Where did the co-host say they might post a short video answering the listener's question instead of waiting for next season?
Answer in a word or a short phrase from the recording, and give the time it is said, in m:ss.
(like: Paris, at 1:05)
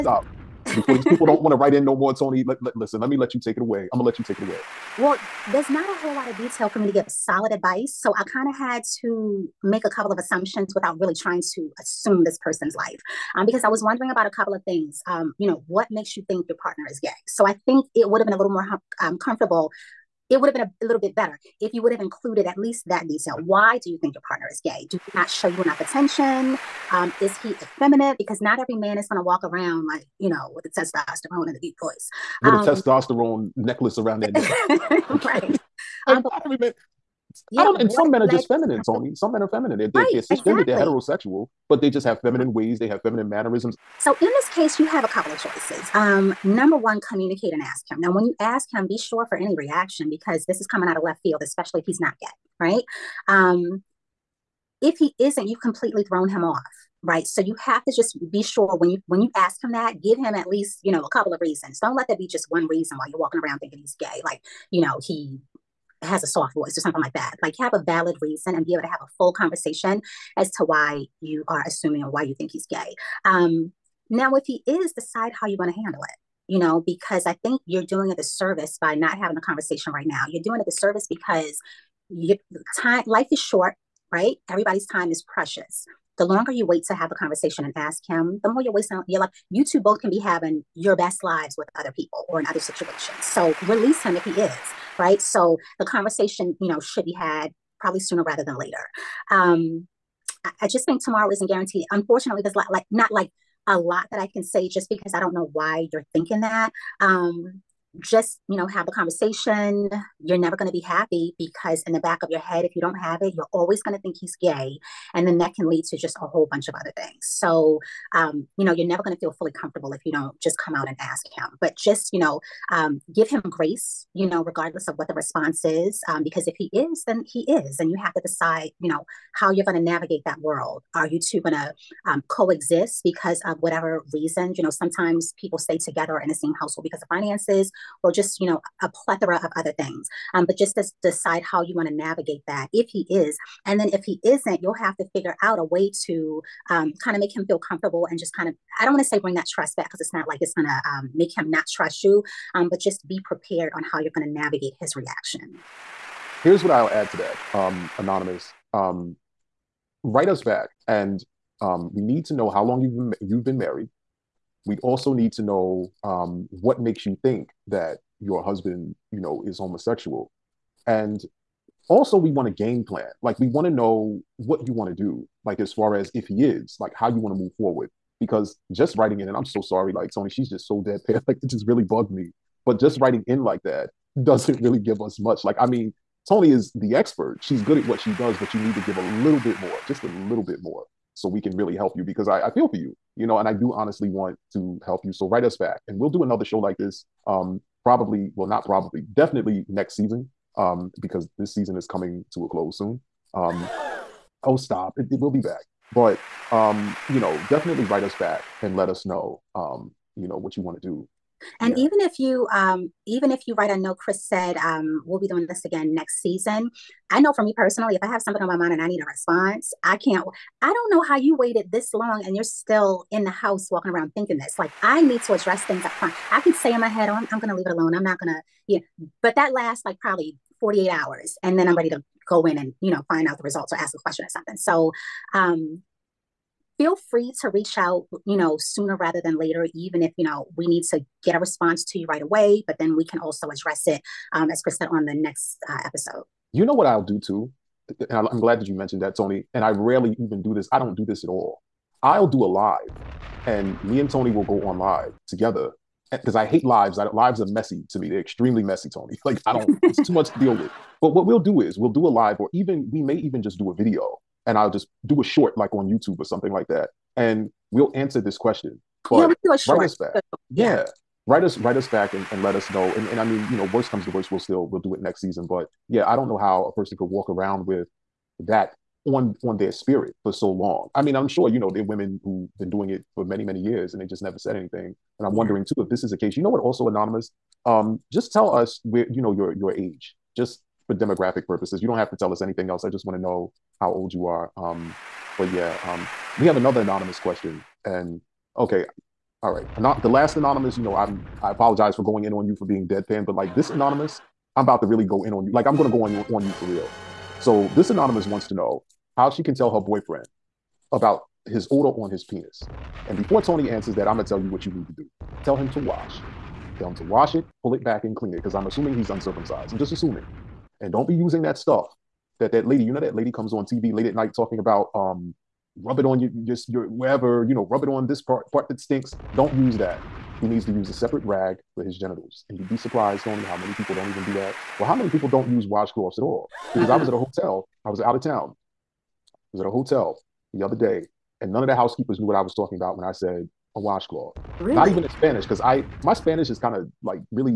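YouTube, at 4:25.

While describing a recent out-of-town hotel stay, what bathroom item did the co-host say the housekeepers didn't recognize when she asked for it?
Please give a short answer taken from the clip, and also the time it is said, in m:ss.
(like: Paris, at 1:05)
A washcloth, at 5:43.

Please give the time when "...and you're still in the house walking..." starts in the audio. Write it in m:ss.
3:42.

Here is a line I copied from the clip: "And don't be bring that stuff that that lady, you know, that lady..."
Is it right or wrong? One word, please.
wrong.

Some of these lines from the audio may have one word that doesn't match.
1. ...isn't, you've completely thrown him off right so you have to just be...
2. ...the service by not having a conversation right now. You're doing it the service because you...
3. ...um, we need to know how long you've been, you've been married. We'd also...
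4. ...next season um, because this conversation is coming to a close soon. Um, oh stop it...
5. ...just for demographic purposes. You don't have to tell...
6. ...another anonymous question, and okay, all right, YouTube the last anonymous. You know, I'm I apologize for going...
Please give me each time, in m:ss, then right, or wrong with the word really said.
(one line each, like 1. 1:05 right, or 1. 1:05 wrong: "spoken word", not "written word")
1. 0:55 right
2. 1:18 right
3. 2:41 right
4. 3:19 wrong: "season", not "conversation"
5. 4:50 right
6. 4:56 wrong: "Not", not "YouTube".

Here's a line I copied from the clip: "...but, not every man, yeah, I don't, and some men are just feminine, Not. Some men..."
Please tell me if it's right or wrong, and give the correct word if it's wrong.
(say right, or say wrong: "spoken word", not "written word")
wrong: "Toni", not "Not".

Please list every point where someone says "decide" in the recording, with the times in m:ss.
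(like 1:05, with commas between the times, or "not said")
1:14, 2:08, 2:21.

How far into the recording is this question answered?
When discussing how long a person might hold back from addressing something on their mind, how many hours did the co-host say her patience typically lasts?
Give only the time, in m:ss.
3:50.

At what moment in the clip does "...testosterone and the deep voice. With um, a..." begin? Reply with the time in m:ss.
0:30.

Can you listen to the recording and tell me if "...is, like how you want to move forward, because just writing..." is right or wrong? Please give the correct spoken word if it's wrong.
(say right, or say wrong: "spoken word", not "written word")
right.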